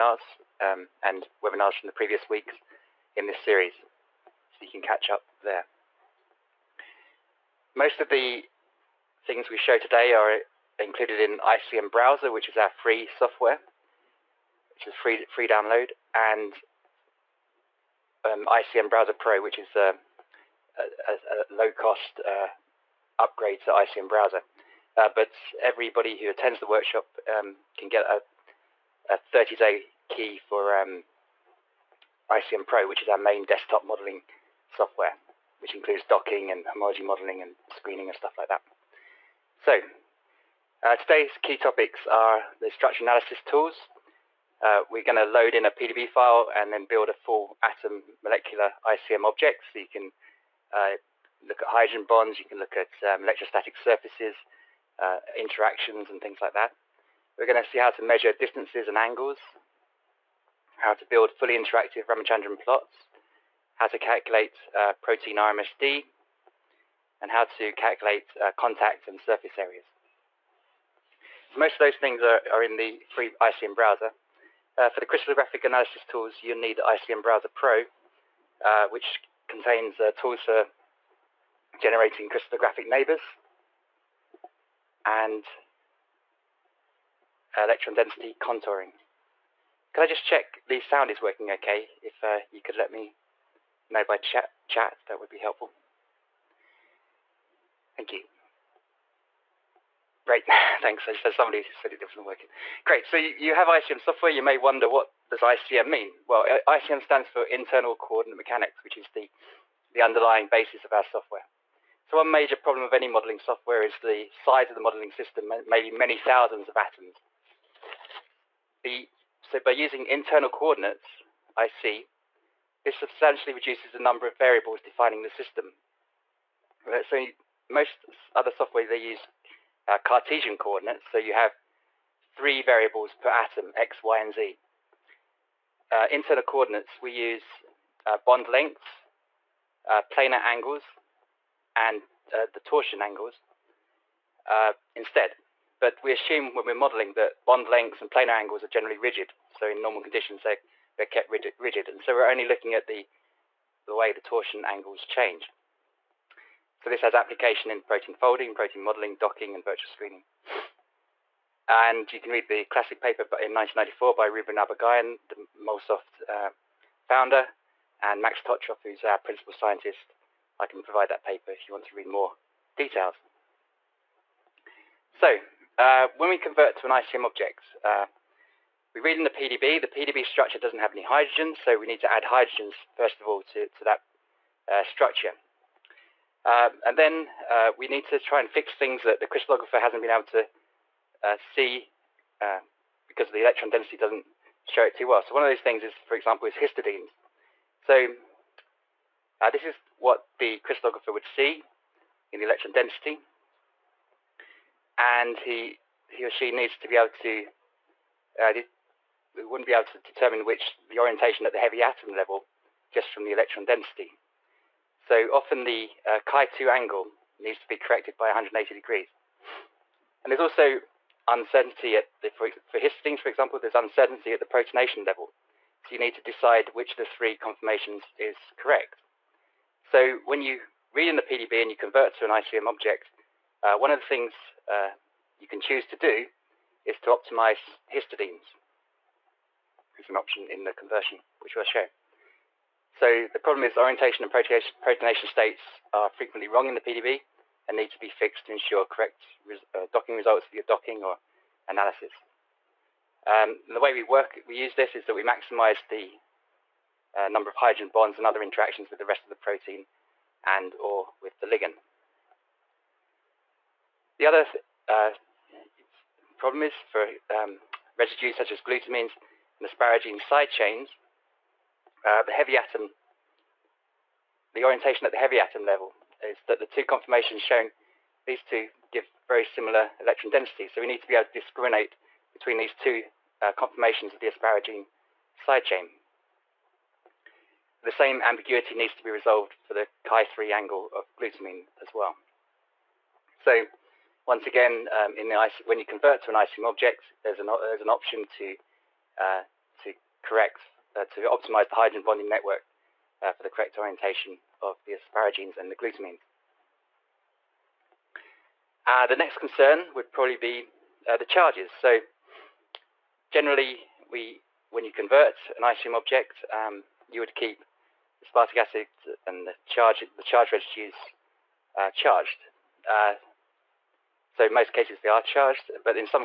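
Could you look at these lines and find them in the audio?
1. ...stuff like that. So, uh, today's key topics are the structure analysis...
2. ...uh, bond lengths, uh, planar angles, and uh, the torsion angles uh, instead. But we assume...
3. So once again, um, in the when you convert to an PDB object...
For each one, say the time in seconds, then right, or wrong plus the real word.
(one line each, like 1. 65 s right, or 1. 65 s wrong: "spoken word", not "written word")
1. 38 s right
2. 138 s right
3. 293 s wrong: "ICM", not "PDB".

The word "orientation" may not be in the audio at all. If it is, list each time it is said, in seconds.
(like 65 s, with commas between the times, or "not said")
210 s, 243 s, 274 s, 303 s.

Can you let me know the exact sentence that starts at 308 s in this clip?
Uh, the next concern would probably be uh, the charges.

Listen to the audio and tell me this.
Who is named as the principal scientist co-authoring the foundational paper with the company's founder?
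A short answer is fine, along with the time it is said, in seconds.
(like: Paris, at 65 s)
Max Totrov, at 168 s.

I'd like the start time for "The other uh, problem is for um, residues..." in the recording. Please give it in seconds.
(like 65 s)
264 s.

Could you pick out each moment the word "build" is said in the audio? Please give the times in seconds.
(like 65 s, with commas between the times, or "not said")
46 s, 61 s.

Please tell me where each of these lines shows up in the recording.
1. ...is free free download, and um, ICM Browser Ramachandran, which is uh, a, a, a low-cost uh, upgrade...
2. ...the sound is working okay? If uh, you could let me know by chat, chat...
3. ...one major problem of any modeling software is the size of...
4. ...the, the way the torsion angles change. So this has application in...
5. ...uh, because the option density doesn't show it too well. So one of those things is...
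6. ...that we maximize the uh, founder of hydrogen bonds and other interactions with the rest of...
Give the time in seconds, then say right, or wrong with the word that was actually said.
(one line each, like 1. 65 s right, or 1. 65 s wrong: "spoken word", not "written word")
1. 14 s wrong: "Pro", not "Ramachandran"
2. 90 s right
3. 112 s right
4. 152 s right
5. 192 s wrong: "electron", not "option"
6. 255 s wrong: "number", not "founder".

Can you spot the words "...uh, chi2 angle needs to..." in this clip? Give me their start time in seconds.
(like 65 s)
216 s.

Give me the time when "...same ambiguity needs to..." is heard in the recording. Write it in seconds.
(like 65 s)
287 s.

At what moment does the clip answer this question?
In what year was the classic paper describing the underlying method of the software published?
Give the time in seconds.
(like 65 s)
163 s.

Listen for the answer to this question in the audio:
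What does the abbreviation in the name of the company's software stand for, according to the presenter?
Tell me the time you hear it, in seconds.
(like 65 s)
107 s.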